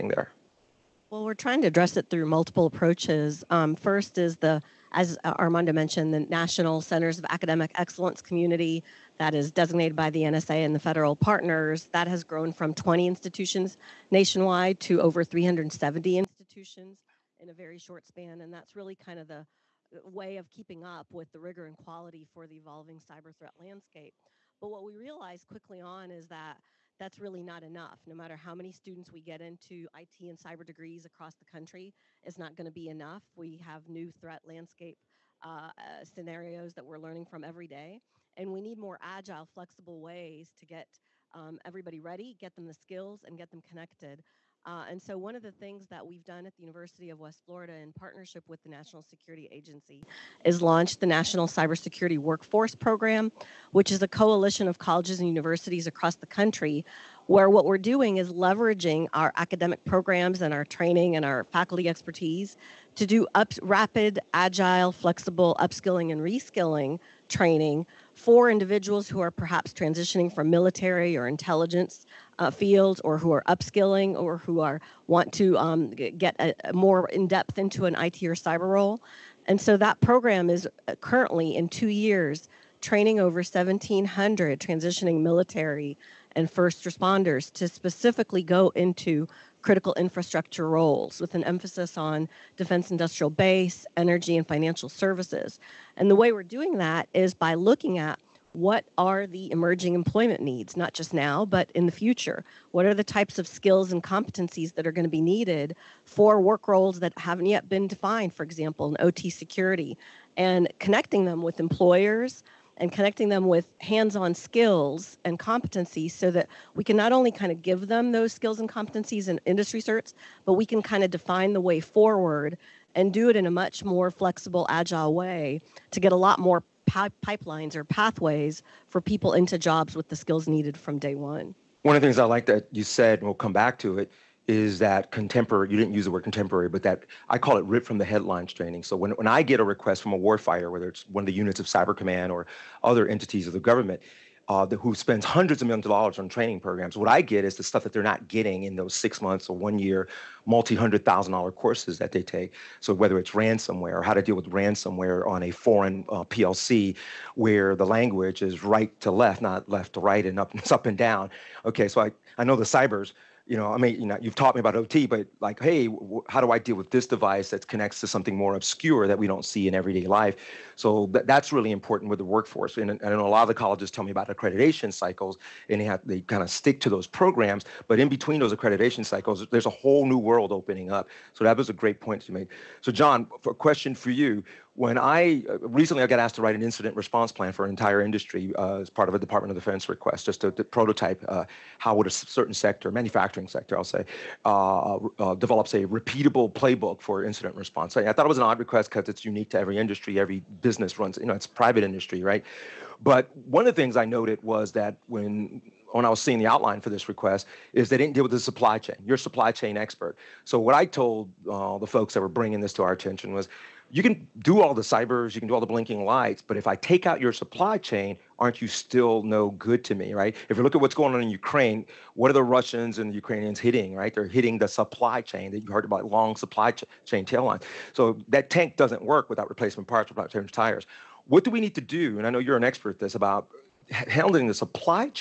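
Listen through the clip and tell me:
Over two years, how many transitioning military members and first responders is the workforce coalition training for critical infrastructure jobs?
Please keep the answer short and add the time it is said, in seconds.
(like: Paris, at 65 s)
1,700, at 83 s.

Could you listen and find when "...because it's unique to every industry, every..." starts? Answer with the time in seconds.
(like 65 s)
198 s.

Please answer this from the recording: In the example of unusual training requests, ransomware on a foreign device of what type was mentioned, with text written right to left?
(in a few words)
PLC.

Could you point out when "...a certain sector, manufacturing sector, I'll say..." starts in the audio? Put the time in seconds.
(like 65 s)
192 s.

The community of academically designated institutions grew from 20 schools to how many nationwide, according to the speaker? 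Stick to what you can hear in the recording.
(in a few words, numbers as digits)
370.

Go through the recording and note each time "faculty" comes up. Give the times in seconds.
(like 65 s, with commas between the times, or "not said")
61 s.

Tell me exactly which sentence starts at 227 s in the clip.
So that tank doesn't work without replacement parts, without change tires.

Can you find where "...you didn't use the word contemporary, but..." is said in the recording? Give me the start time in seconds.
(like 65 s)
135 s.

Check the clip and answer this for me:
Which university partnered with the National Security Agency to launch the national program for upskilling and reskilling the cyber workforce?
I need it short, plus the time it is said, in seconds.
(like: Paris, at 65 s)
University of West Florida, at 46 s.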